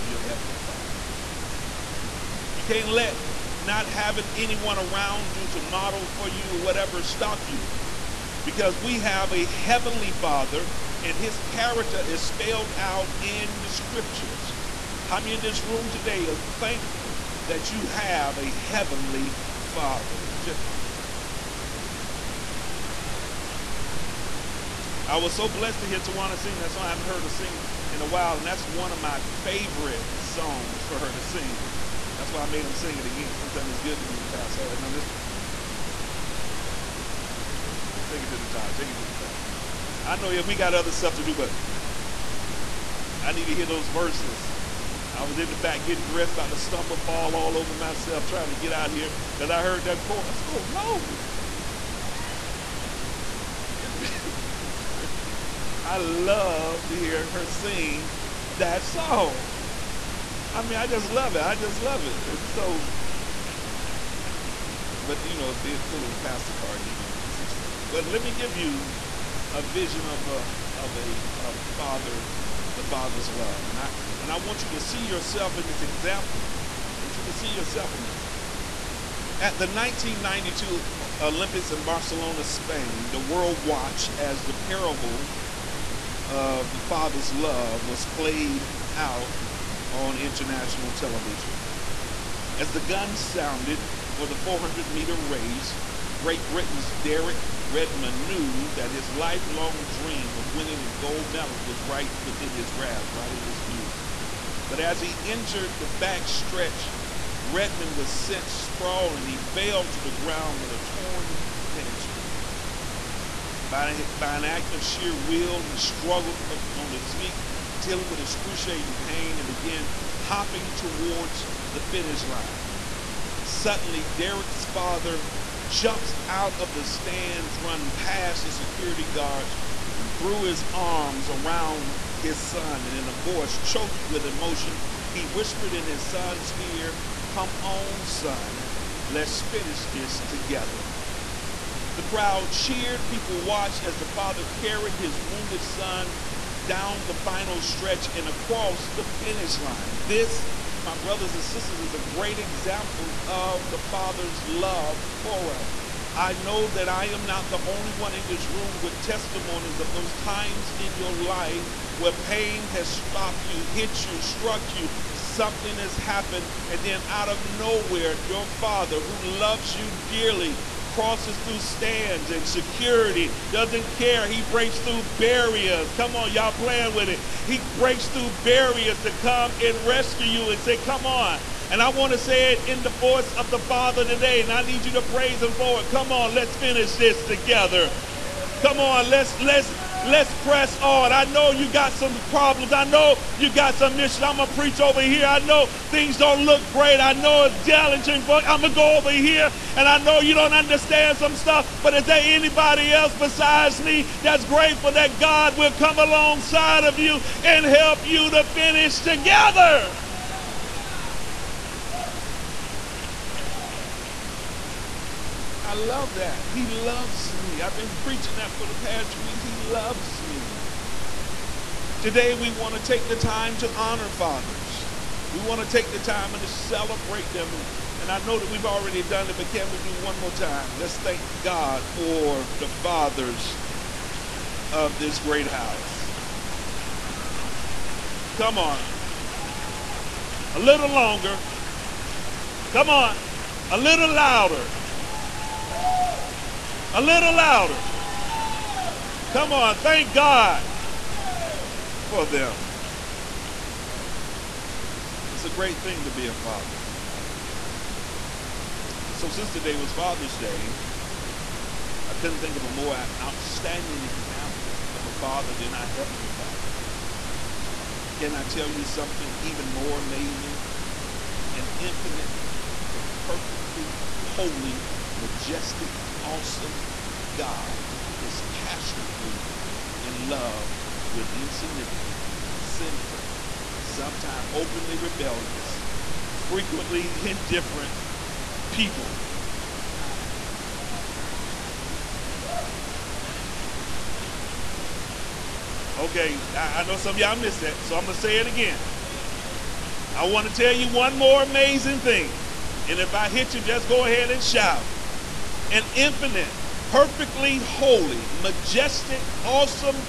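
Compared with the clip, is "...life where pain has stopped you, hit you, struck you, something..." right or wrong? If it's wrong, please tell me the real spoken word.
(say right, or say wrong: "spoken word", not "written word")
right.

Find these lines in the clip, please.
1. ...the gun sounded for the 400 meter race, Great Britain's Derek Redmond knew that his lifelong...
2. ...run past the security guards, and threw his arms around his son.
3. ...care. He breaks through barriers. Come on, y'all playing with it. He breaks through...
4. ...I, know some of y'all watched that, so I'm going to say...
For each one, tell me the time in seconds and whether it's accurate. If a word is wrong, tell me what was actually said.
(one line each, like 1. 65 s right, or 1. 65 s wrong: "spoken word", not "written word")
1. 92 s right
2. 127 s right
3. 173 s right
4. 296 s wrong: "missed", not "watched".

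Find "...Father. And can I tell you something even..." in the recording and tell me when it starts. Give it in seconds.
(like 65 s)
266 s.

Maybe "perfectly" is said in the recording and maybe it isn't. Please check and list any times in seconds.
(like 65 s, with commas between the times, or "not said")
273 s, 306 s.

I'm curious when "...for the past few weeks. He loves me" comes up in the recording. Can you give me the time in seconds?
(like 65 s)
218 s.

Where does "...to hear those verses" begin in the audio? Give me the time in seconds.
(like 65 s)
43 s.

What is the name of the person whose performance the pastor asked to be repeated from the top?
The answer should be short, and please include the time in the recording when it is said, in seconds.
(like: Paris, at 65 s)
Tawana, at 25 s.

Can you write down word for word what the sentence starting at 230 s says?
Let's thank God for the fathers of this great house.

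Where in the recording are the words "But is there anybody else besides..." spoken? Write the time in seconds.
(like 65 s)
201 s.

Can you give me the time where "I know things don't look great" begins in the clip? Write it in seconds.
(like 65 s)
195 s.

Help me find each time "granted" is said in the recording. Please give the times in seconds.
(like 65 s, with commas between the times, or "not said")
not said.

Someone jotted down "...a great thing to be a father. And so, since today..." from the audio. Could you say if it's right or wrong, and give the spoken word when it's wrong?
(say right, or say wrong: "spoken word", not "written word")
right.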